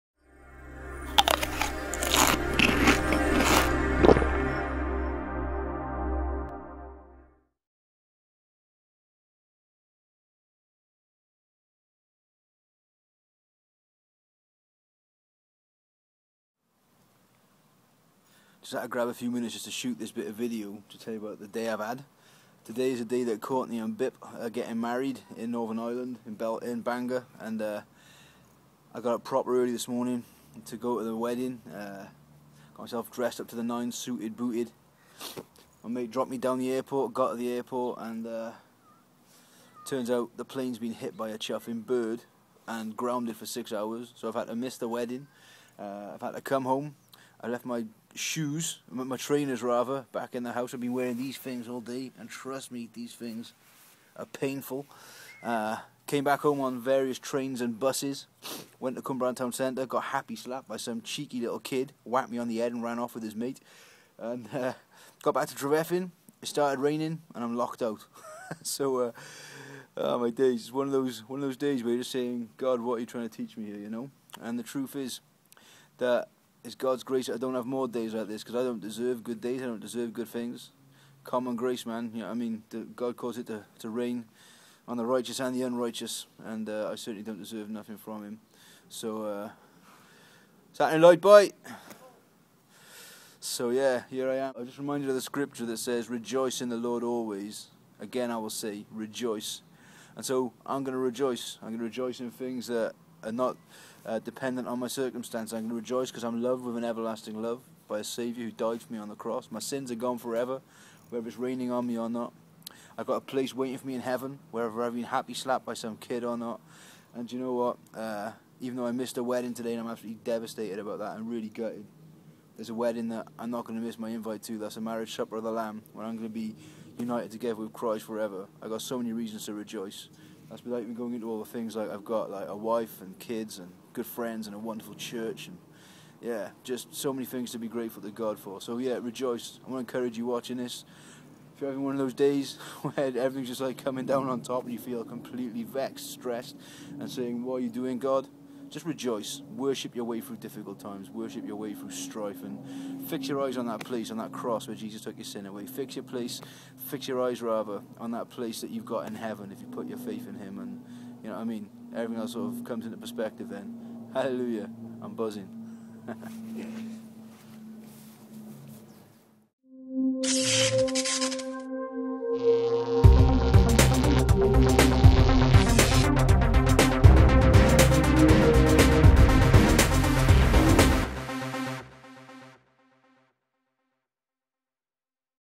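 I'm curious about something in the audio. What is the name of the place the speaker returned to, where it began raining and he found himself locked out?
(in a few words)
Trevethin.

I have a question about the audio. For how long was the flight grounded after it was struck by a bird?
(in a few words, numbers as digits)
6 hours.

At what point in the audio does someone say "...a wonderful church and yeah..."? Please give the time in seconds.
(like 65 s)
134 s.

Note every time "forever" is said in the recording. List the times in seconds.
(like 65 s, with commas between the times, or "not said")
110 s, 128 s.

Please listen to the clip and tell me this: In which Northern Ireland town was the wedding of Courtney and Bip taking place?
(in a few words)
Bangor.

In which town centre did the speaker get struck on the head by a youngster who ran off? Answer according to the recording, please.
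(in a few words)
Cwmbran.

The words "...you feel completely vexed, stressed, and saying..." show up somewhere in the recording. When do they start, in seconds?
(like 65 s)
144 s.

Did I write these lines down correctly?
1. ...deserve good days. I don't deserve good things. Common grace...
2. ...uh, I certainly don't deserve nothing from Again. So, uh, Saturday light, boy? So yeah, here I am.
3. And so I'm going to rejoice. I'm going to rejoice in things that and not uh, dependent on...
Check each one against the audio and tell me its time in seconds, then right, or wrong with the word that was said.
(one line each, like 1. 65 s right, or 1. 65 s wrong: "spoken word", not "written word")
1. 78 s right
2. 86 s wrong: "Him", not "Again"
3. 100 s right.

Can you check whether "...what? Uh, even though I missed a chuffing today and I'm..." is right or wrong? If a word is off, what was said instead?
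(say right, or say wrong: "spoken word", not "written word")
wrong: "wedding", not "chuffing".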